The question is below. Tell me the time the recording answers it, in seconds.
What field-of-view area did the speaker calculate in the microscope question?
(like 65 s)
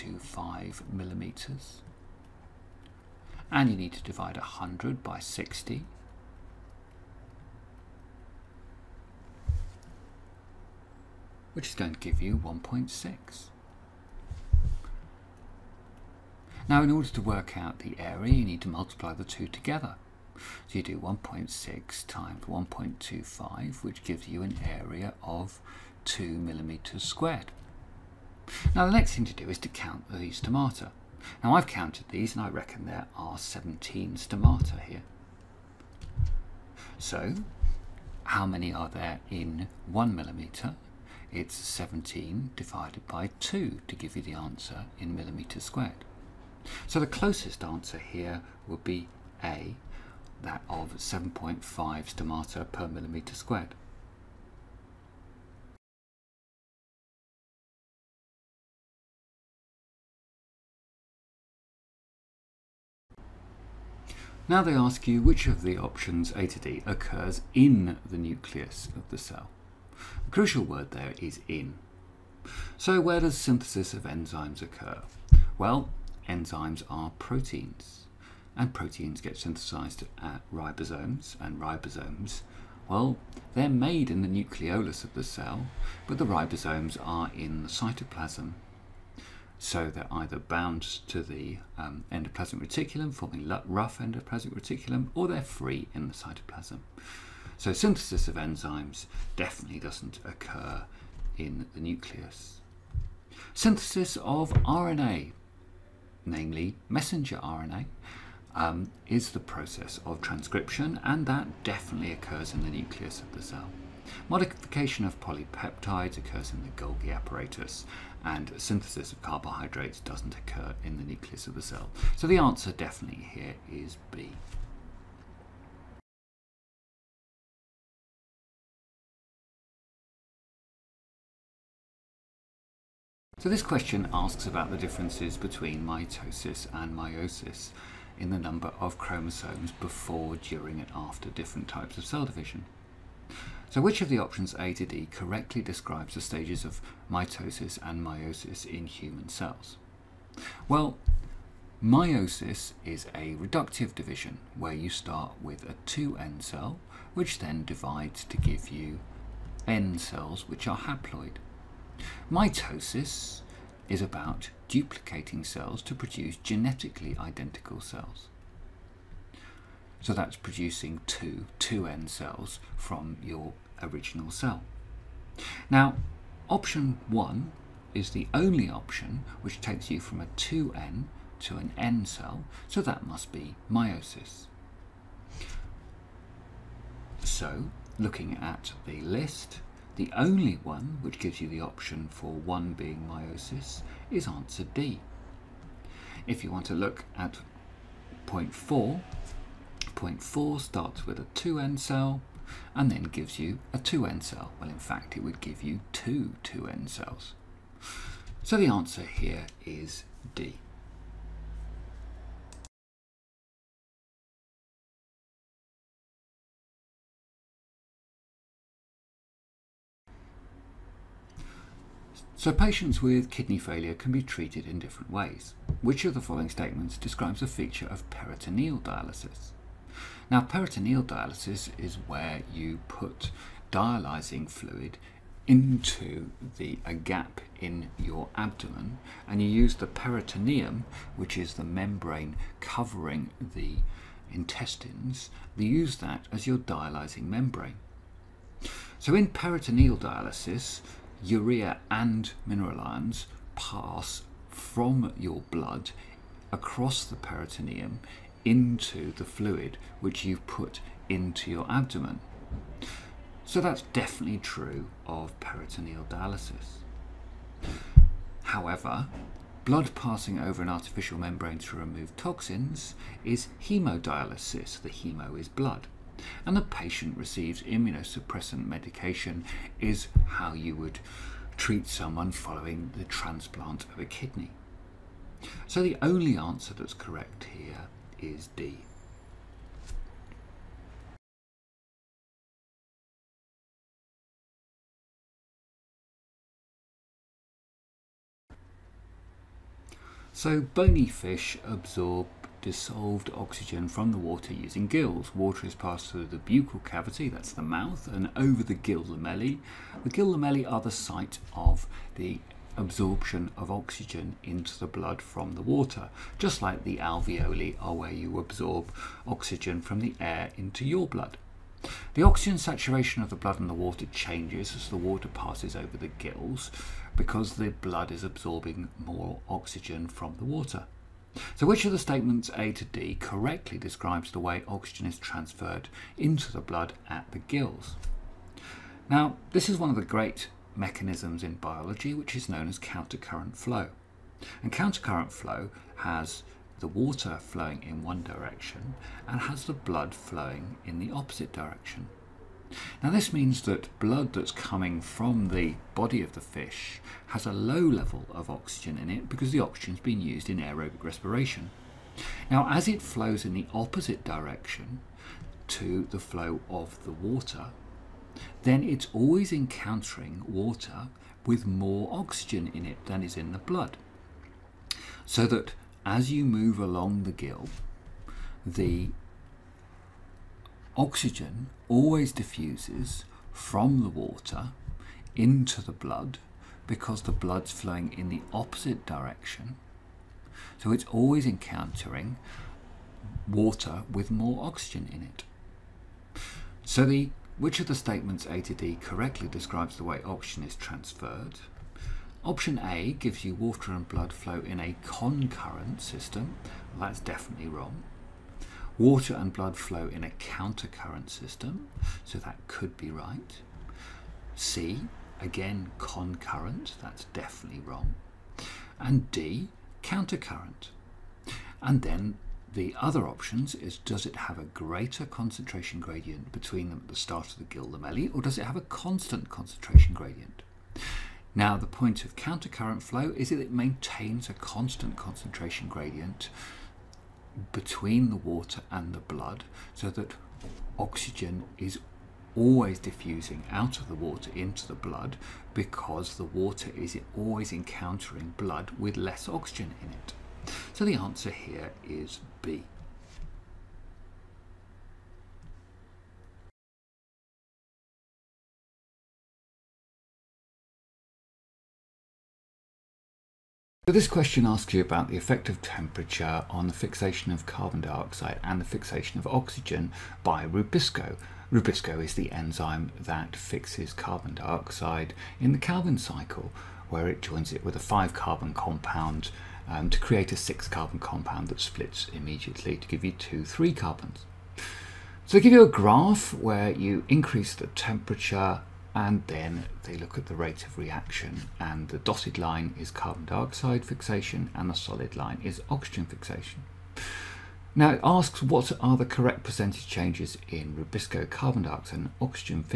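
26 s.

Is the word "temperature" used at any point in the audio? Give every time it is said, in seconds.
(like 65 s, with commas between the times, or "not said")
465 s, 487 s.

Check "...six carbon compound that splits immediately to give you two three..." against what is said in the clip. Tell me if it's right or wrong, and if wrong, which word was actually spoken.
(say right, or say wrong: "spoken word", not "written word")
right.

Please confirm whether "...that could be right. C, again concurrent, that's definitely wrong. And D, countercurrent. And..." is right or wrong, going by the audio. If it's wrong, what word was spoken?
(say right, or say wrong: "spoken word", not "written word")
right.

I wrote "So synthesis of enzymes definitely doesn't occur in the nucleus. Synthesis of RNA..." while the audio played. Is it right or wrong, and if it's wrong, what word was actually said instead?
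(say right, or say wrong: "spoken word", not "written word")
right.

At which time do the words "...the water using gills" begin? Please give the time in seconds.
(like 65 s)
304 s.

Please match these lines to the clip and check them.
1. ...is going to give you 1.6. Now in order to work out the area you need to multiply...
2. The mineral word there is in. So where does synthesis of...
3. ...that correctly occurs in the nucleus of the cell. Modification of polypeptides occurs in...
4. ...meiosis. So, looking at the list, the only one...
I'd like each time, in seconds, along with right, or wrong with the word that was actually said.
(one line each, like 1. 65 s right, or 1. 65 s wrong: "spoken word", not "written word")
1. 11 s right
2. 70 s wrong: "crucial", not "mineral"
3. 111 s wrong: "definitely", not "correctly"
4. 183 s right.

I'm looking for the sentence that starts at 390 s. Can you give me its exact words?
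So it's always encountering water with more oxygen in it.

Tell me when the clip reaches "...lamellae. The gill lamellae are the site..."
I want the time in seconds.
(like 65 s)
309 s.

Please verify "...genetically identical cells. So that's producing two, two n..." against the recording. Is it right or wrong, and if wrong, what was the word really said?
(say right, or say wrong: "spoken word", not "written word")
right.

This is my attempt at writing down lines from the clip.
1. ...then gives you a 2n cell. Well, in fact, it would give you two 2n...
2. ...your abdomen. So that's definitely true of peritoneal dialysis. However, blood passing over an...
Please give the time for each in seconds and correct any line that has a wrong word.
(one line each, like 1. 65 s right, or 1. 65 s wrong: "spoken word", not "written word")
1. 202 s right
2. 261 s right.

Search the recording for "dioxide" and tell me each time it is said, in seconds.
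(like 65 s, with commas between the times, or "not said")
468 s, 474 s, 493 s, 501 s.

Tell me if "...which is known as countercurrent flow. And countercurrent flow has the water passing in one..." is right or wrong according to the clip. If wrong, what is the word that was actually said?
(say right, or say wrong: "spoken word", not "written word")
wrong: "flowing", not "passing".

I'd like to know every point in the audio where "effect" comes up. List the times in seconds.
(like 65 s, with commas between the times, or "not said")
465 s.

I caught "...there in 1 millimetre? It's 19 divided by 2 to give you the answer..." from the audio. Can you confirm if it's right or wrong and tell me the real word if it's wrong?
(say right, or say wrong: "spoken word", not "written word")
wrong: "17", not "19".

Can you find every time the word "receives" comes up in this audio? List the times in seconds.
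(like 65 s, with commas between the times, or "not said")
277 s.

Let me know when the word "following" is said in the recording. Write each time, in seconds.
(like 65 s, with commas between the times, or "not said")
226 s, 282 s.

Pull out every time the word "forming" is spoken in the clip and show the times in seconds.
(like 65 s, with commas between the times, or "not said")
93 s.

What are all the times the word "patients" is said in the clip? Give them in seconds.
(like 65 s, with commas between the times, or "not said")
222 s, 276 s.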